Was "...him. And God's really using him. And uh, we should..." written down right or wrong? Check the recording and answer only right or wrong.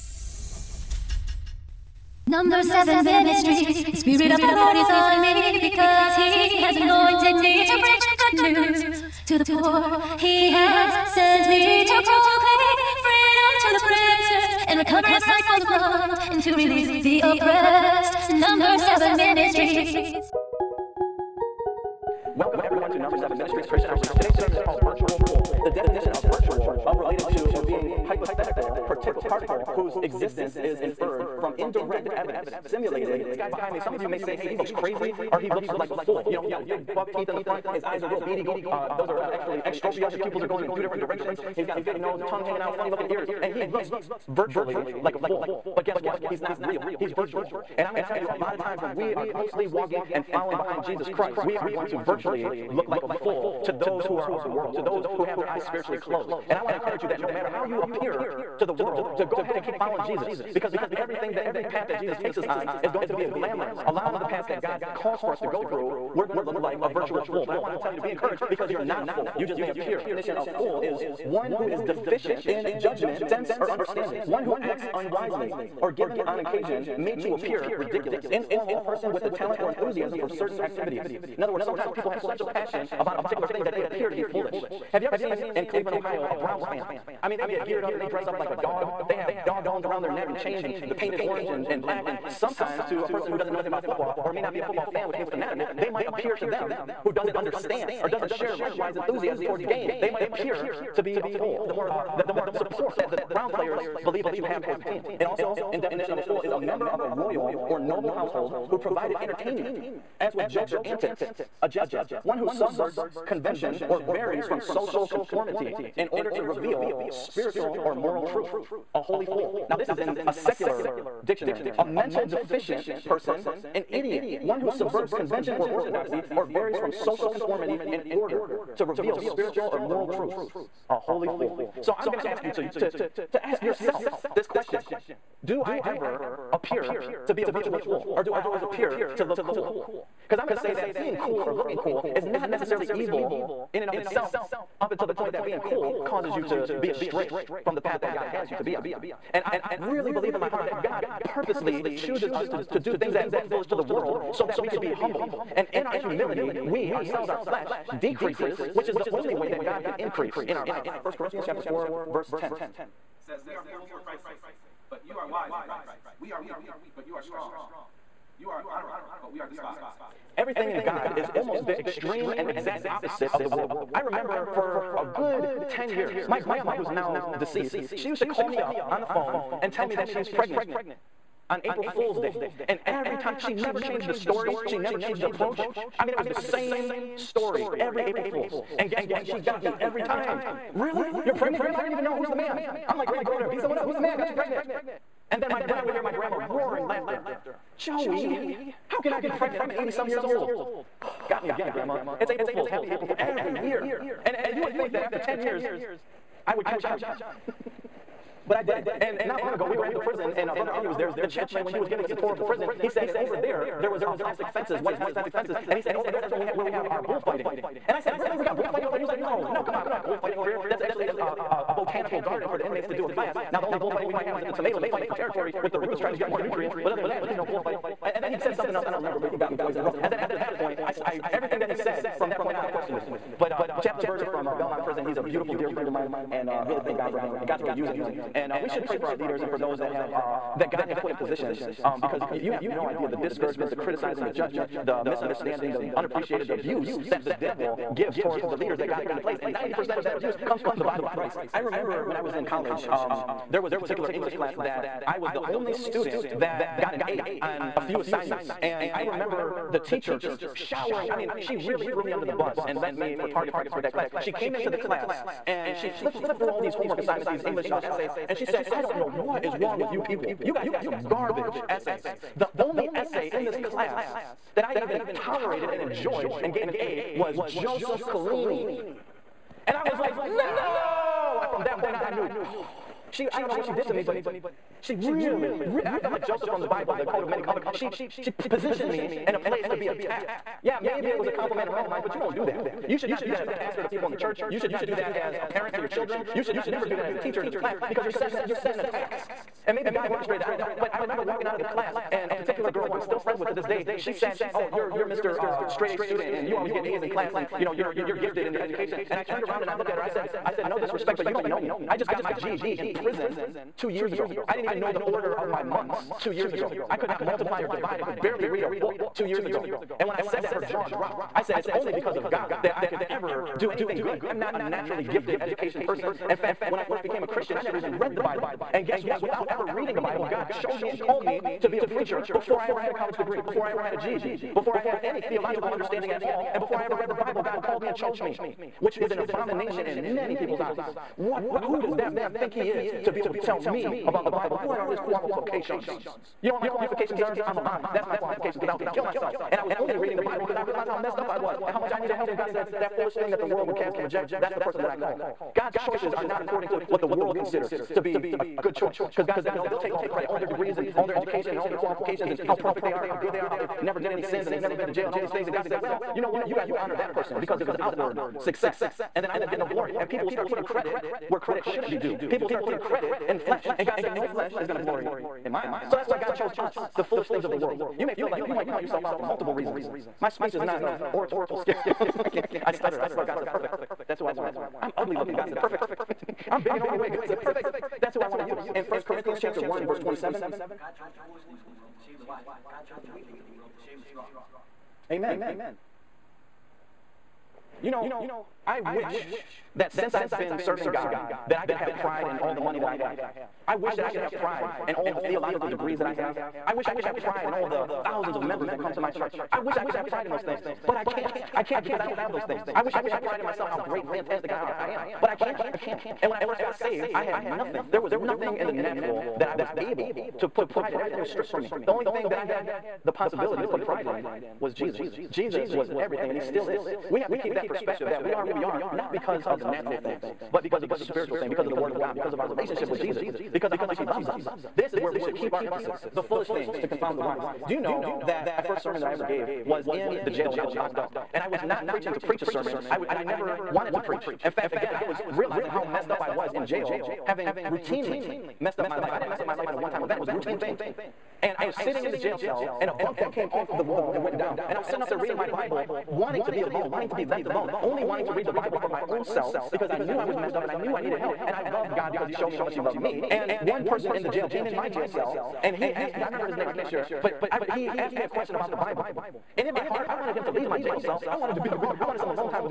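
right.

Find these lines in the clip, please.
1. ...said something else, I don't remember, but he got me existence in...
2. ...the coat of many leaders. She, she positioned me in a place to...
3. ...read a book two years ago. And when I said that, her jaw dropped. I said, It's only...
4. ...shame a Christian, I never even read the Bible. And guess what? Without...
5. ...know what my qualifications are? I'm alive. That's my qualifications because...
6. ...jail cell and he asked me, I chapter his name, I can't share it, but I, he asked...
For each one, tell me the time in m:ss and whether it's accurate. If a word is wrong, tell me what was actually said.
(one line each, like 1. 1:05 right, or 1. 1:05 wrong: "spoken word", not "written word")
1. 3:48 wrong: "twice", not "existence"
2. 4:46 wrong: "colors", not "leaders"
3. 5:18 right
4. 5:27 wrong: "became", not "shame"
5. 5:46 right
6. 7:44 wrong: "remember", not "chapter".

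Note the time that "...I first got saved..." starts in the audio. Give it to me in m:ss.
6:56.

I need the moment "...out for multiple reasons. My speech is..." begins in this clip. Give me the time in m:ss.
6:19.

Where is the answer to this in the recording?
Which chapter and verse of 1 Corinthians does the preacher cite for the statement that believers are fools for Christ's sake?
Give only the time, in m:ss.
2:41.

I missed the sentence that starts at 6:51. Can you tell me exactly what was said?
I can't because I don't have those things.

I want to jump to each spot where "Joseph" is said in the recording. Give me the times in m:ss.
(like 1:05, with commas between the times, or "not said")
4:37, 4:46.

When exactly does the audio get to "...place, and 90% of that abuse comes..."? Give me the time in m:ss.
4:09.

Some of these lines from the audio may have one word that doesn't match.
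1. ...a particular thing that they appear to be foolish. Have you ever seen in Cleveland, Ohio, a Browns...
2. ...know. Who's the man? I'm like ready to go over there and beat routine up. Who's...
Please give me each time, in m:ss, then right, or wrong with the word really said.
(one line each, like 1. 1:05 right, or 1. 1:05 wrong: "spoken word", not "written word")
1. 1:23 right
2. 3:12 wrong: "someone", not "routine".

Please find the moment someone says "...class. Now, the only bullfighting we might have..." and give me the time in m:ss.
3:43.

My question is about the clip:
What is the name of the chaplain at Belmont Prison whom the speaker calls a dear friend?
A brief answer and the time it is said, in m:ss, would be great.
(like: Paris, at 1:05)
Chaplain Berger, at 3:53.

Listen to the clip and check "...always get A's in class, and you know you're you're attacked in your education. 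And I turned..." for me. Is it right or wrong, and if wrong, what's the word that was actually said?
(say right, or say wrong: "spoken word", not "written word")
wrong: "gifted", not "attacked".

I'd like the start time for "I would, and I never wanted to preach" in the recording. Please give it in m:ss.
7:22.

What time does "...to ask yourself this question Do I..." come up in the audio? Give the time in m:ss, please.
2:13.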